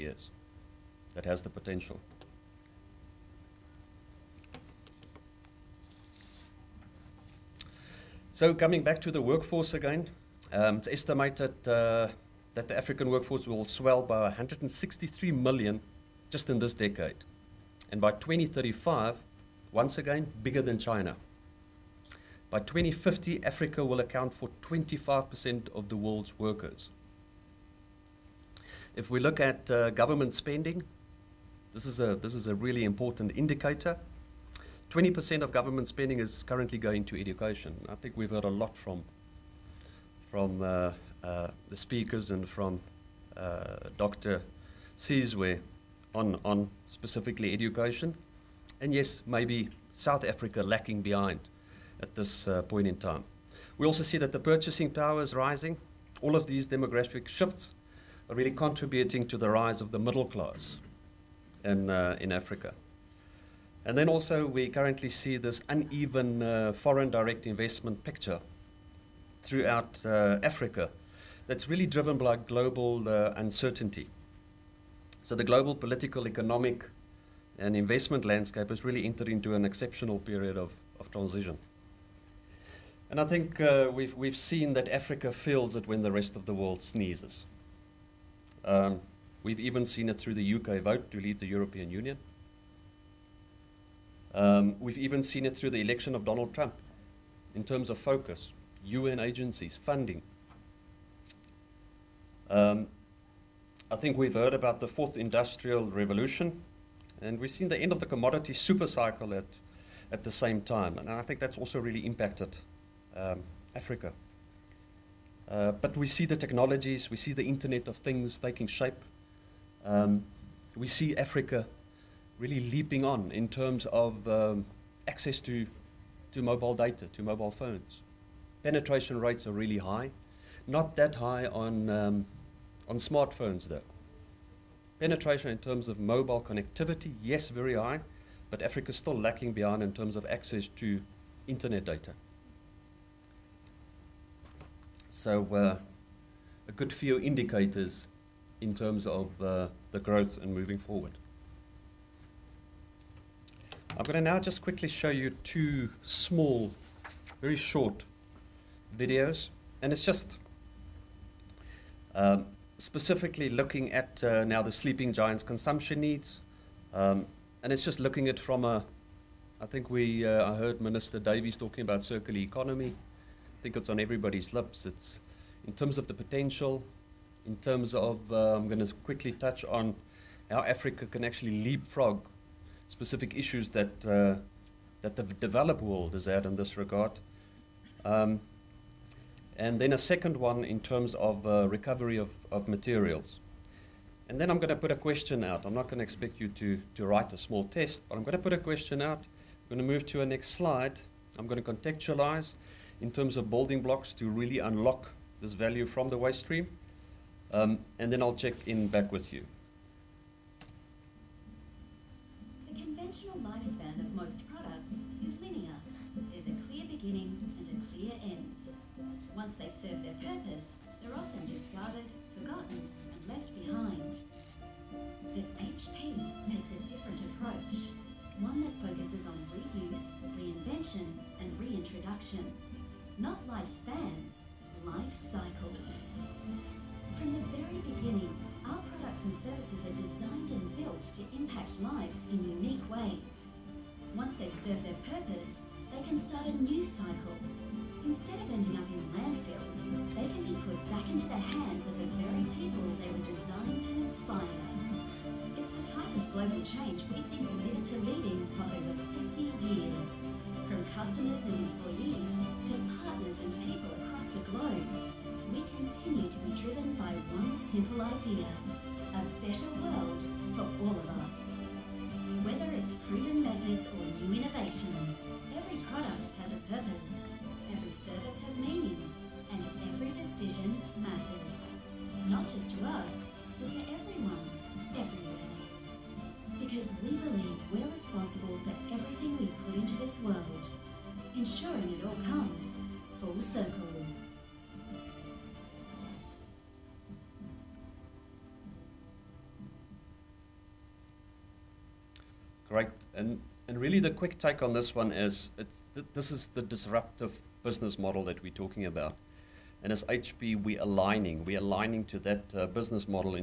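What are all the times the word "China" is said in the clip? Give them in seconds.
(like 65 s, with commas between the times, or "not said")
20 s.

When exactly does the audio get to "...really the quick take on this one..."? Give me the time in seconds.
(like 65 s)
303 s.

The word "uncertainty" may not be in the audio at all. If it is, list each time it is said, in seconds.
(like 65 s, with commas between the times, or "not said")
73 s.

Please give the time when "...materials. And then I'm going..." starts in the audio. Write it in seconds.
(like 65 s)
192 s.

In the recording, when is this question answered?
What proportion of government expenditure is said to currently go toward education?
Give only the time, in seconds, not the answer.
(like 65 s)
34 s.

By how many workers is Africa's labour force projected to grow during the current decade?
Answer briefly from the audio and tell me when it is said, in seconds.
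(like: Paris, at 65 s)
163 million, at 14 s.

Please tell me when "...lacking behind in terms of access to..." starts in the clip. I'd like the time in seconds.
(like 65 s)
139 s.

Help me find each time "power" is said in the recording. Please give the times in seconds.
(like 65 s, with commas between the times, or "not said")
54 s.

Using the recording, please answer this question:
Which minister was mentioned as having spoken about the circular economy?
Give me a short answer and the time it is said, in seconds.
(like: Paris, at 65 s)
Minister Davies, at 170 s.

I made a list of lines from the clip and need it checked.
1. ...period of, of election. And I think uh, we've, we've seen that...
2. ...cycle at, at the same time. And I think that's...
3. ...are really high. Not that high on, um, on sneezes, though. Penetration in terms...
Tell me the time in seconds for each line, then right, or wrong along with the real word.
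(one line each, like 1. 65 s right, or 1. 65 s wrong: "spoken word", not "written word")
1. 80 s wrong: "transition", not "election"
2. 108 s right
3. 129 s wrong: "smartphones", not "sneezes".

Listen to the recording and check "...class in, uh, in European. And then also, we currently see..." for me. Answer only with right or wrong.
wrong.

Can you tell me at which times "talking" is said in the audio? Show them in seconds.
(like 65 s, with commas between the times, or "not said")
171 s, 308 s.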